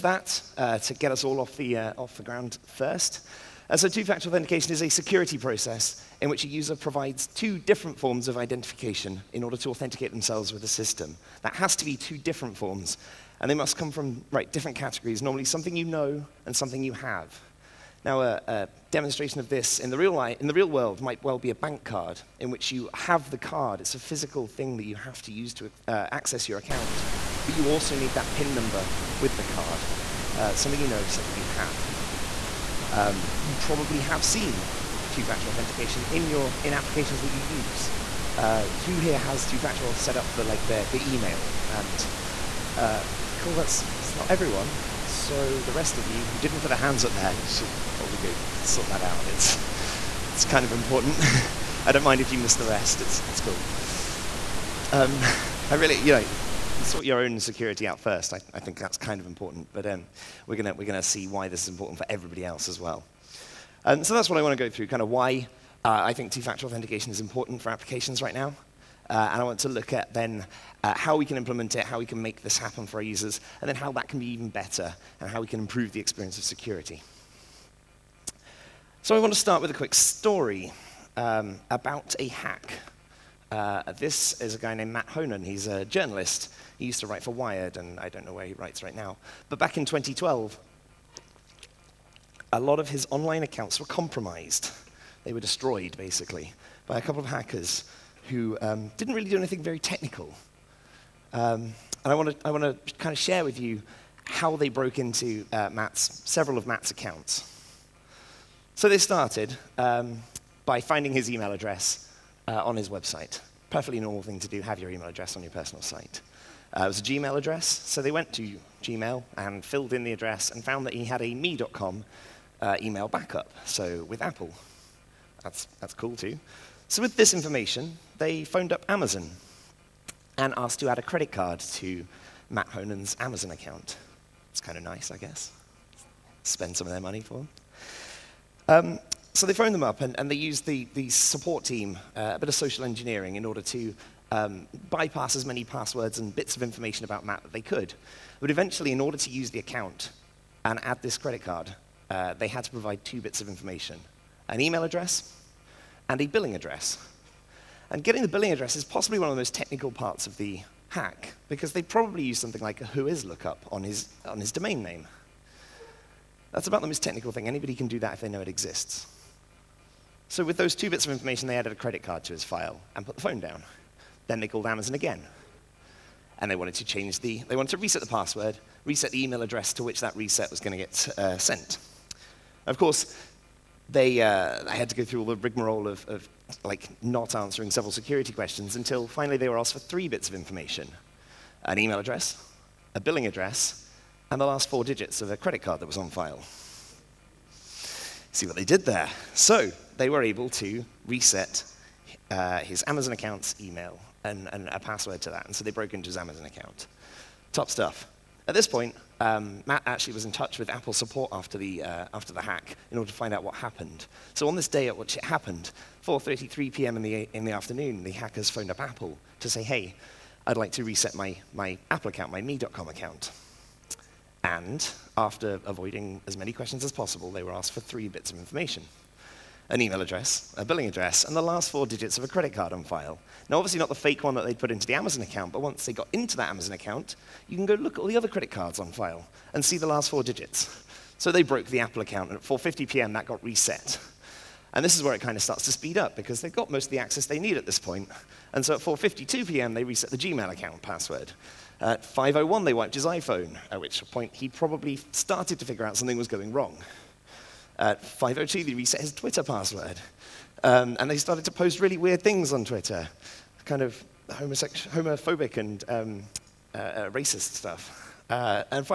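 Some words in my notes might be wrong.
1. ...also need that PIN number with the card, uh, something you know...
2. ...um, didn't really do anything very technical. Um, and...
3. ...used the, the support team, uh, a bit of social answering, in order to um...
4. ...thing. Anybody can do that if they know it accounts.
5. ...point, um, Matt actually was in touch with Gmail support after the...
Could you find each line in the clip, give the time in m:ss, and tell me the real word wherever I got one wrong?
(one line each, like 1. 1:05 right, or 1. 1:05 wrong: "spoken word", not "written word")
1. 0:27 right
2. 1:38 right
3. 2:20 wrong: "engineering", not "answering"
4. 2:47 wrong: "exists", not "accounts"
5. 3:28 wrong: "Apple", not "Gmail".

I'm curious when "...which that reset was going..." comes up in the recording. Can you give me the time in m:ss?
2:59.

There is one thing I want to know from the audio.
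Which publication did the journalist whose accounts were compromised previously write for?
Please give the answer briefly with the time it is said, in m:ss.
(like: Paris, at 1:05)
Wired, at 1:27.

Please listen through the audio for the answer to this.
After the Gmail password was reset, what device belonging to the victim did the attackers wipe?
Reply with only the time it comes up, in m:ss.
4:13.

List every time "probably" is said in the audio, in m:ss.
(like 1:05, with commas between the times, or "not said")
0:33, 0:47, 2:41, 4:14.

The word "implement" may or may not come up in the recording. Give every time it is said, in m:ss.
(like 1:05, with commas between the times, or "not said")
1:11.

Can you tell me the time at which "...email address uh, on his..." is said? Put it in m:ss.
1:51.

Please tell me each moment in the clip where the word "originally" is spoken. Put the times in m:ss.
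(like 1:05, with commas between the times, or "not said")
not said.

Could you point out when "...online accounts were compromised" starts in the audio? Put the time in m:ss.
1:33.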